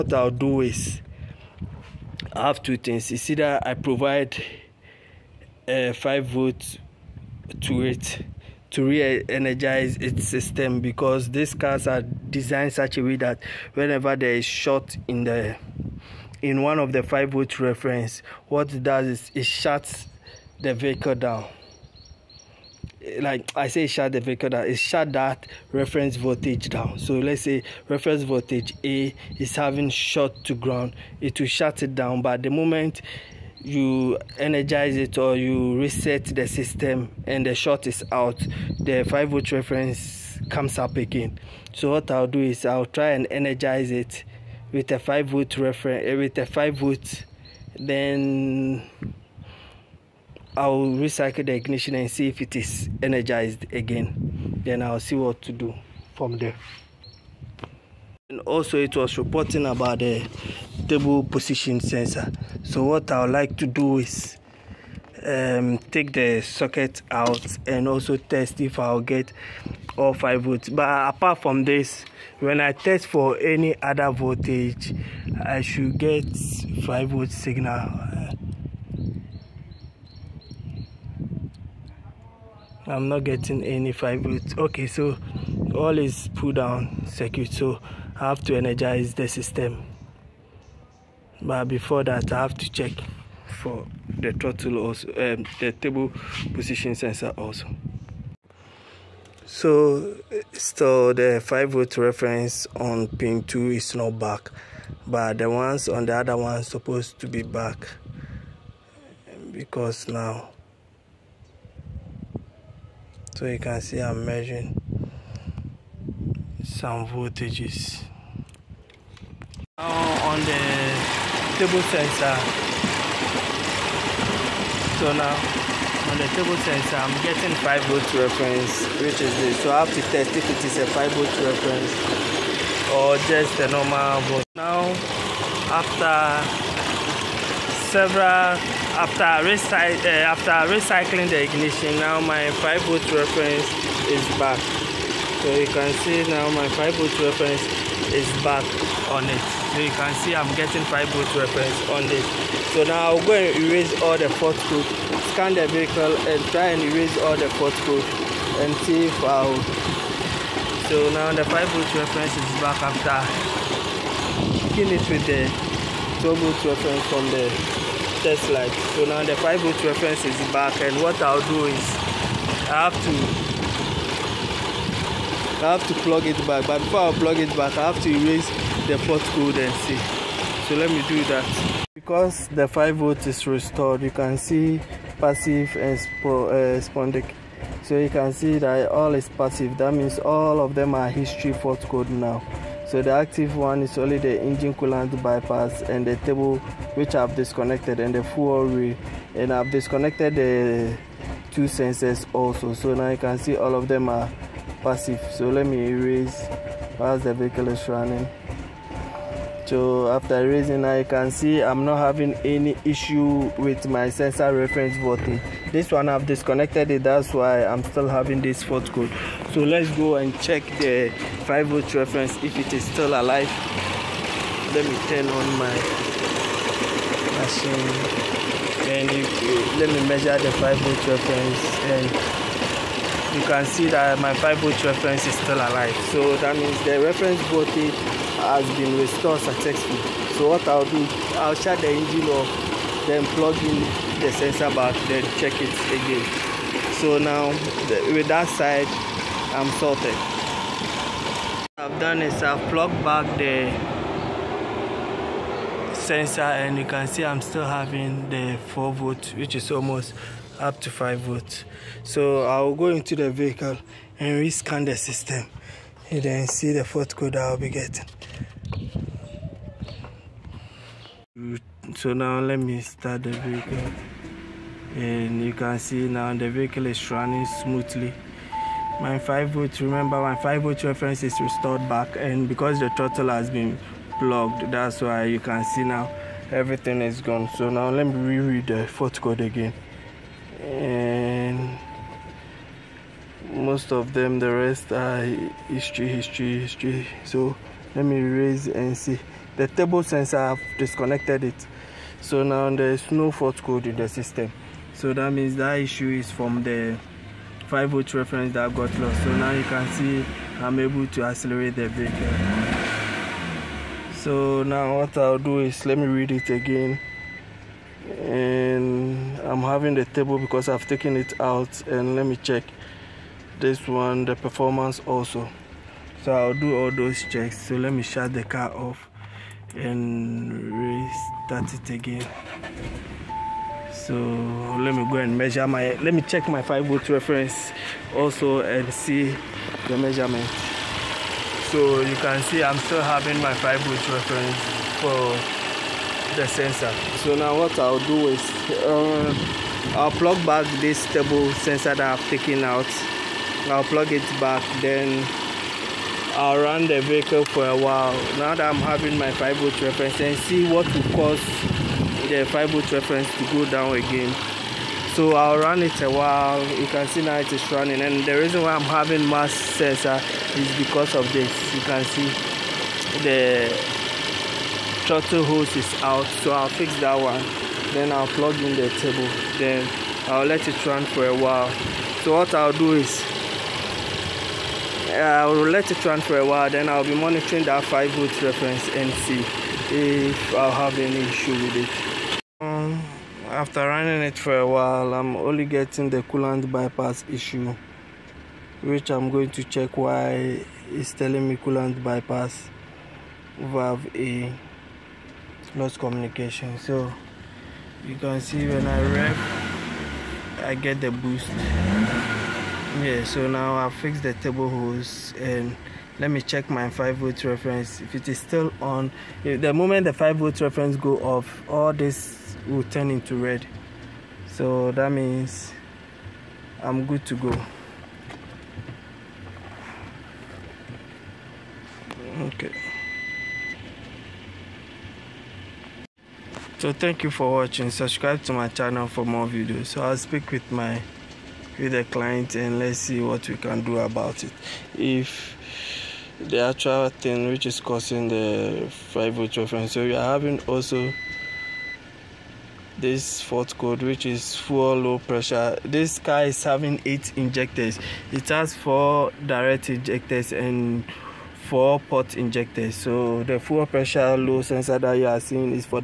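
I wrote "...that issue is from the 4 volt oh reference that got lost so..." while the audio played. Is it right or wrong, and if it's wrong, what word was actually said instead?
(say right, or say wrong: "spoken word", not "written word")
wrong: "5", not "4".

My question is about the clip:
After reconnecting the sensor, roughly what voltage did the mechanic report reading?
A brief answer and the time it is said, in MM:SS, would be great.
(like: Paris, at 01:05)
4 volt, at 04:18.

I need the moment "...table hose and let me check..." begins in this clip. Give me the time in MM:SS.
06:54.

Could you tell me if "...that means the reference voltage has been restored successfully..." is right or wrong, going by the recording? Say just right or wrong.
right.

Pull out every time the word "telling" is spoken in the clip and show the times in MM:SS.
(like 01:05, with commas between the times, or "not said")
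06:41.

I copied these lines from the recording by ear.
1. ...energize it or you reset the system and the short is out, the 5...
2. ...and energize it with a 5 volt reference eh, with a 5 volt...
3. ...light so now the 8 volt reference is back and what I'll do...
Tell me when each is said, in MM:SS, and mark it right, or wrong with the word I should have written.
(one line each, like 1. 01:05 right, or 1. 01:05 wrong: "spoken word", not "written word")
1. 00:34 right
2. 00:43 right
3. 02:48 wrong: "5", not "8".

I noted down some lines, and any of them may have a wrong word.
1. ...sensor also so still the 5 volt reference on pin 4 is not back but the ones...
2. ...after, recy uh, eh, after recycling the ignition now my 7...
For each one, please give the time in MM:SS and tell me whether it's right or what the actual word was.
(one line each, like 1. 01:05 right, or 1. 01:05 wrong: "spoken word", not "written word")
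1. 01:36 wrong: "2", not "4"
2. 02:18 wrong: "5", not "7".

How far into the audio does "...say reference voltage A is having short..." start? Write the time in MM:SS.
00:27.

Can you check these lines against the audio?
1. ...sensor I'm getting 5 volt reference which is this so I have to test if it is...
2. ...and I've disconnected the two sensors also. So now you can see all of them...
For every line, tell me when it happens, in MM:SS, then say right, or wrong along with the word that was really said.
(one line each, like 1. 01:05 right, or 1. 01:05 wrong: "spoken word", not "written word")
1. 02:06 right
2. 03:19 right.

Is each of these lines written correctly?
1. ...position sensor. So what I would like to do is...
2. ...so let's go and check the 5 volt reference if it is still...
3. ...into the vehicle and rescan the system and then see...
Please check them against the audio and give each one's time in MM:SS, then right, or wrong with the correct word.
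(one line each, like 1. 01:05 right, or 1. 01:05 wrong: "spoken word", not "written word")
1. 01:01 right
2. 03:39 right
3. 04:22 right.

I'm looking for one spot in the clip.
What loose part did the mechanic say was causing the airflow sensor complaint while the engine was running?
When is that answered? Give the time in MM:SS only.
06:15.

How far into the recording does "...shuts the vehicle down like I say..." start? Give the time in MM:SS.
00:19.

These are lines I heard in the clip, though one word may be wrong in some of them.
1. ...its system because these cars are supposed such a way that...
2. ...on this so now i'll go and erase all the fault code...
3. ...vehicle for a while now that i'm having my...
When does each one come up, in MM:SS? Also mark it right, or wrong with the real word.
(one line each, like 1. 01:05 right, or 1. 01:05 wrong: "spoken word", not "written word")
1. 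00:09 wrong: "designed", not "supposed"
2. 02:31 right
3. 05:57 right.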